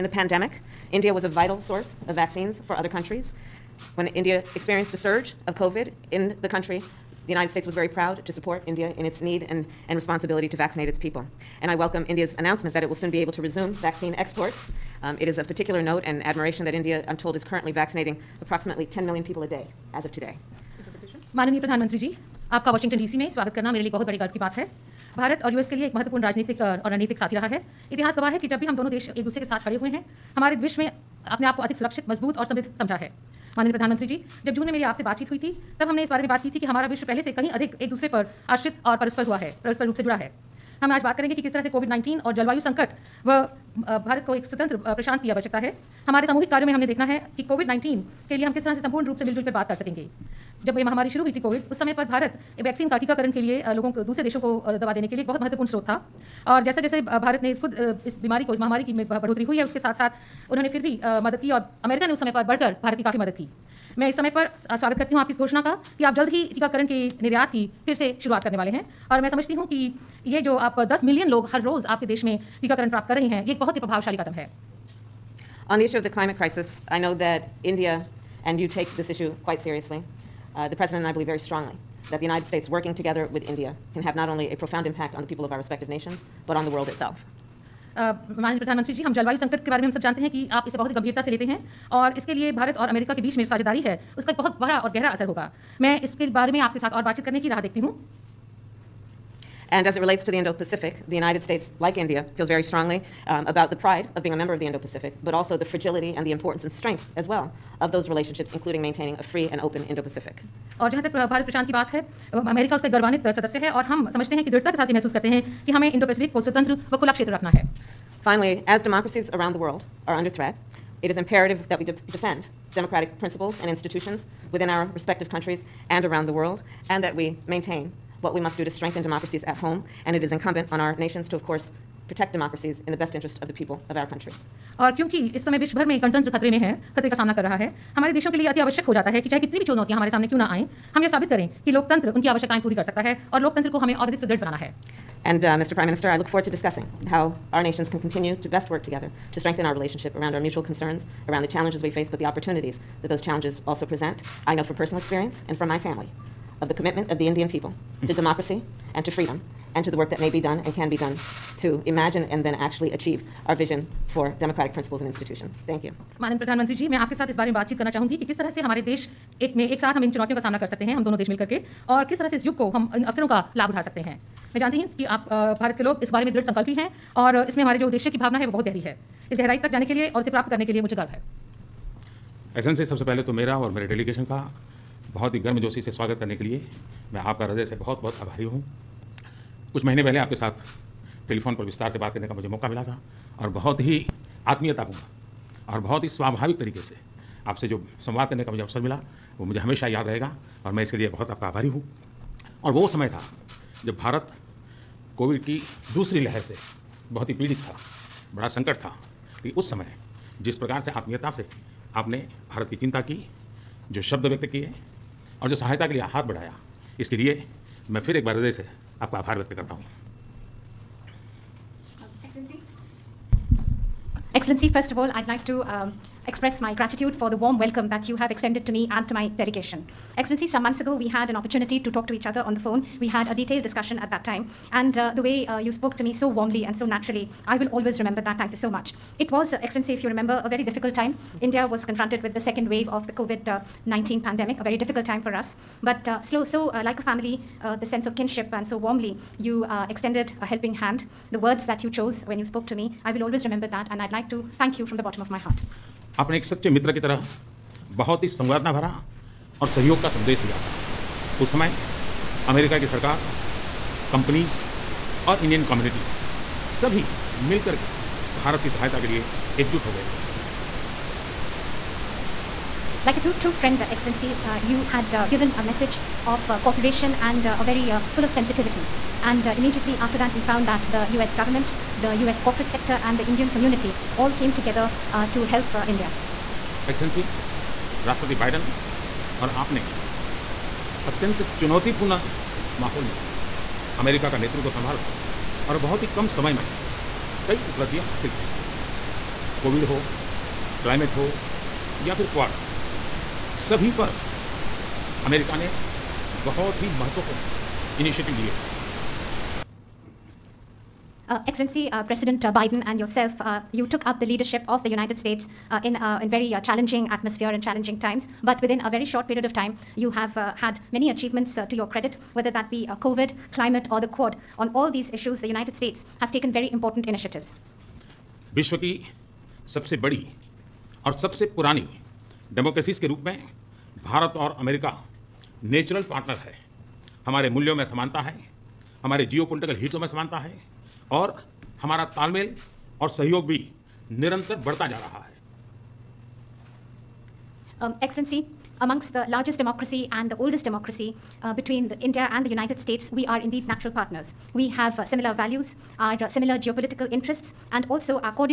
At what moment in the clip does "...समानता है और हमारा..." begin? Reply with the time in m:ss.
5:40.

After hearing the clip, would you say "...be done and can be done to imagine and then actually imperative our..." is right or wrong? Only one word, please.
wrong.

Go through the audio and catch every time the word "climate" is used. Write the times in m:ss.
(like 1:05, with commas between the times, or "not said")
1:16, 5:23.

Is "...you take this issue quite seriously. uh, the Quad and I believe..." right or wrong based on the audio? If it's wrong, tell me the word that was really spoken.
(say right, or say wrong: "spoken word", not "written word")
wrong: "President", not "Quad".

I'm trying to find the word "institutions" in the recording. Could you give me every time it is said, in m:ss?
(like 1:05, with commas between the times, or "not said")
2:03, 2:45.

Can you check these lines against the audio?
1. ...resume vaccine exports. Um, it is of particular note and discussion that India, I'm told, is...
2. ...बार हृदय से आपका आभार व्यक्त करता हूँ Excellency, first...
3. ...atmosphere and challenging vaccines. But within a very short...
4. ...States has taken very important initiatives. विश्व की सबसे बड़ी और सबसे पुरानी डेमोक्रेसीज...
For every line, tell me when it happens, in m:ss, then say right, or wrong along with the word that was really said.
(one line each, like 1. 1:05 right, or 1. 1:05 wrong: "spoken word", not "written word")
1. 0:13 wrong: "admiration", not "discussion"
2. 3:38 right
3. 5:17 wrong: "times", not "vaccines"
4. 5:25 right.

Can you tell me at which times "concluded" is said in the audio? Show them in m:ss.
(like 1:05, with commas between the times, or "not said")
not said.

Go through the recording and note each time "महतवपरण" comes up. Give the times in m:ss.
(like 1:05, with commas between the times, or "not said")
0:25, 0:55, 5:06.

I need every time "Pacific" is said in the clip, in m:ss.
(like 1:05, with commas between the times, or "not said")
1:40, 1:44, 1:50.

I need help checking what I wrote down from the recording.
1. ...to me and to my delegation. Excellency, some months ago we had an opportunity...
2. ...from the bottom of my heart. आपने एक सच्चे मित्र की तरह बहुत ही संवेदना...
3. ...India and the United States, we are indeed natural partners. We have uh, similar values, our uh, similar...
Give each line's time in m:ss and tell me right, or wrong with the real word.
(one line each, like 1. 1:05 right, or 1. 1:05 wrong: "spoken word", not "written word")
1. 3:48 right
2. 4:14 right
3. 5:51 right.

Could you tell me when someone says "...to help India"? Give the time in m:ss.
4:45.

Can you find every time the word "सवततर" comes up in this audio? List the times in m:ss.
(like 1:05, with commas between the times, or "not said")
0:44, 1:56.